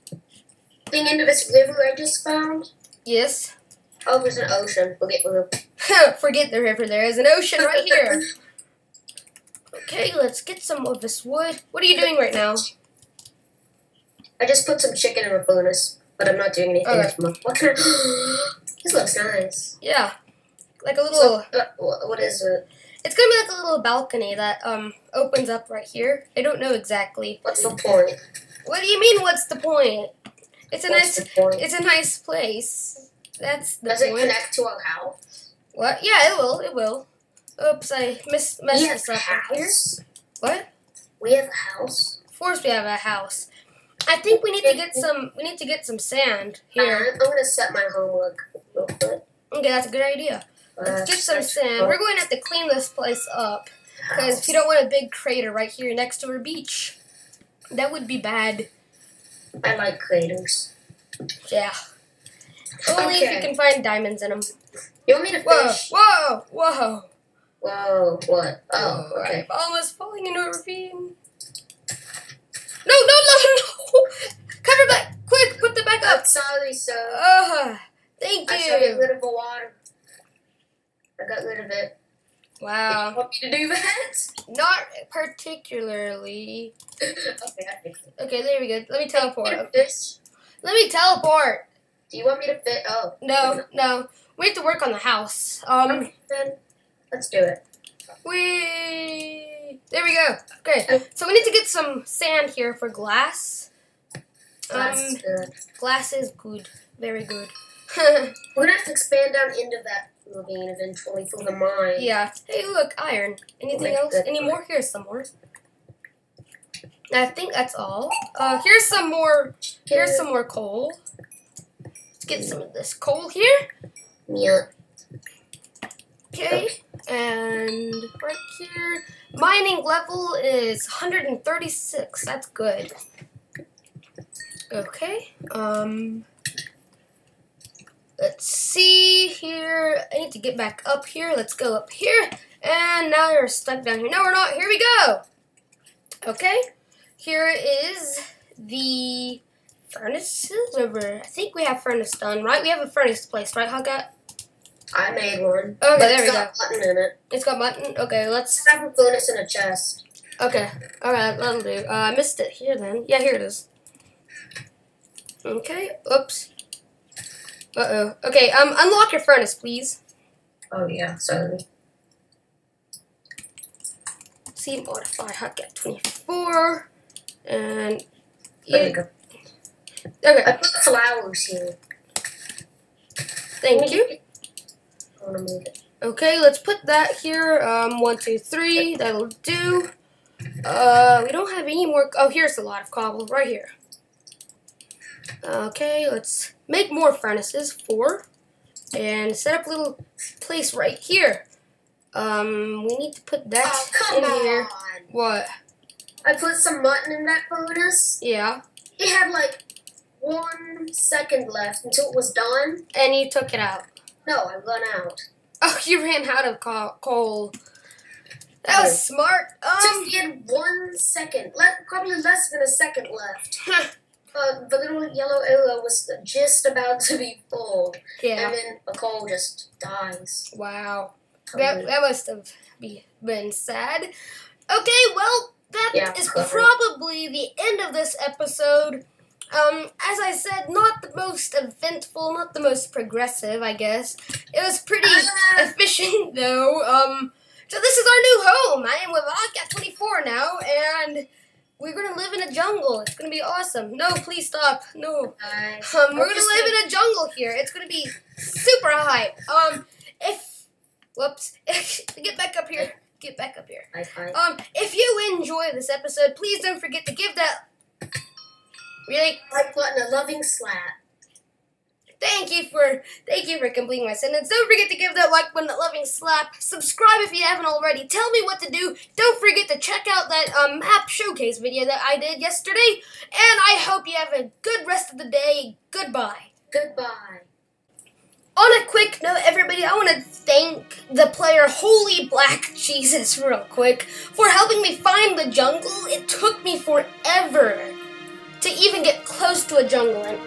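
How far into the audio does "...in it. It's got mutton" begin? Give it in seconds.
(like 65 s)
156 s.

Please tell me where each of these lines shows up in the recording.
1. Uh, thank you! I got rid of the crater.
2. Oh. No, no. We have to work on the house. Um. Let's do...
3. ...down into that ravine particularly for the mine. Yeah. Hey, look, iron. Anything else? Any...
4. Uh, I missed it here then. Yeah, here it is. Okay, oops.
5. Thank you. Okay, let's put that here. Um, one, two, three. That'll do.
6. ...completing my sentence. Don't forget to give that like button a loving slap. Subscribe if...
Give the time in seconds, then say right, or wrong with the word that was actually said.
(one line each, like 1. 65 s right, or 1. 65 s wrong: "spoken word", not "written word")
1. 77 s wrong: "water", not "crater"
2. 92 s right
3. 109 s wrong: "eventually", not "particularly"
4. 161 s right
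5. 183 s right
6. 273 s right.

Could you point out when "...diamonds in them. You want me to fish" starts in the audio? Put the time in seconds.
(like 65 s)
63 s.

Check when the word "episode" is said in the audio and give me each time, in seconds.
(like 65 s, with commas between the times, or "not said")
238 s, 265 s.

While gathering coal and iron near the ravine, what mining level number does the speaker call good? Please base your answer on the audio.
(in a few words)
136.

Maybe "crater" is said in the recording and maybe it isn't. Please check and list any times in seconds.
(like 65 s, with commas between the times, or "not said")
55 s, 59 s.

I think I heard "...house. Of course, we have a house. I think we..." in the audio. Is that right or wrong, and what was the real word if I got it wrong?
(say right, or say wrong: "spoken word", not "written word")
right.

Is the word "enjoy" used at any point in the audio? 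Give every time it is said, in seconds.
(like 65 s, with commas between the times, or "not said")
265 s.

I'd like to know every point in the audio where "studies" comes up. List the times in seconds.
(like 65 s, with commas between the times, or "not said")
not said.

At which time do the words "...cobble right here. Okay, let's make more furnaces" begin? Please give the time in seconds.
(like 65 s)
192 s.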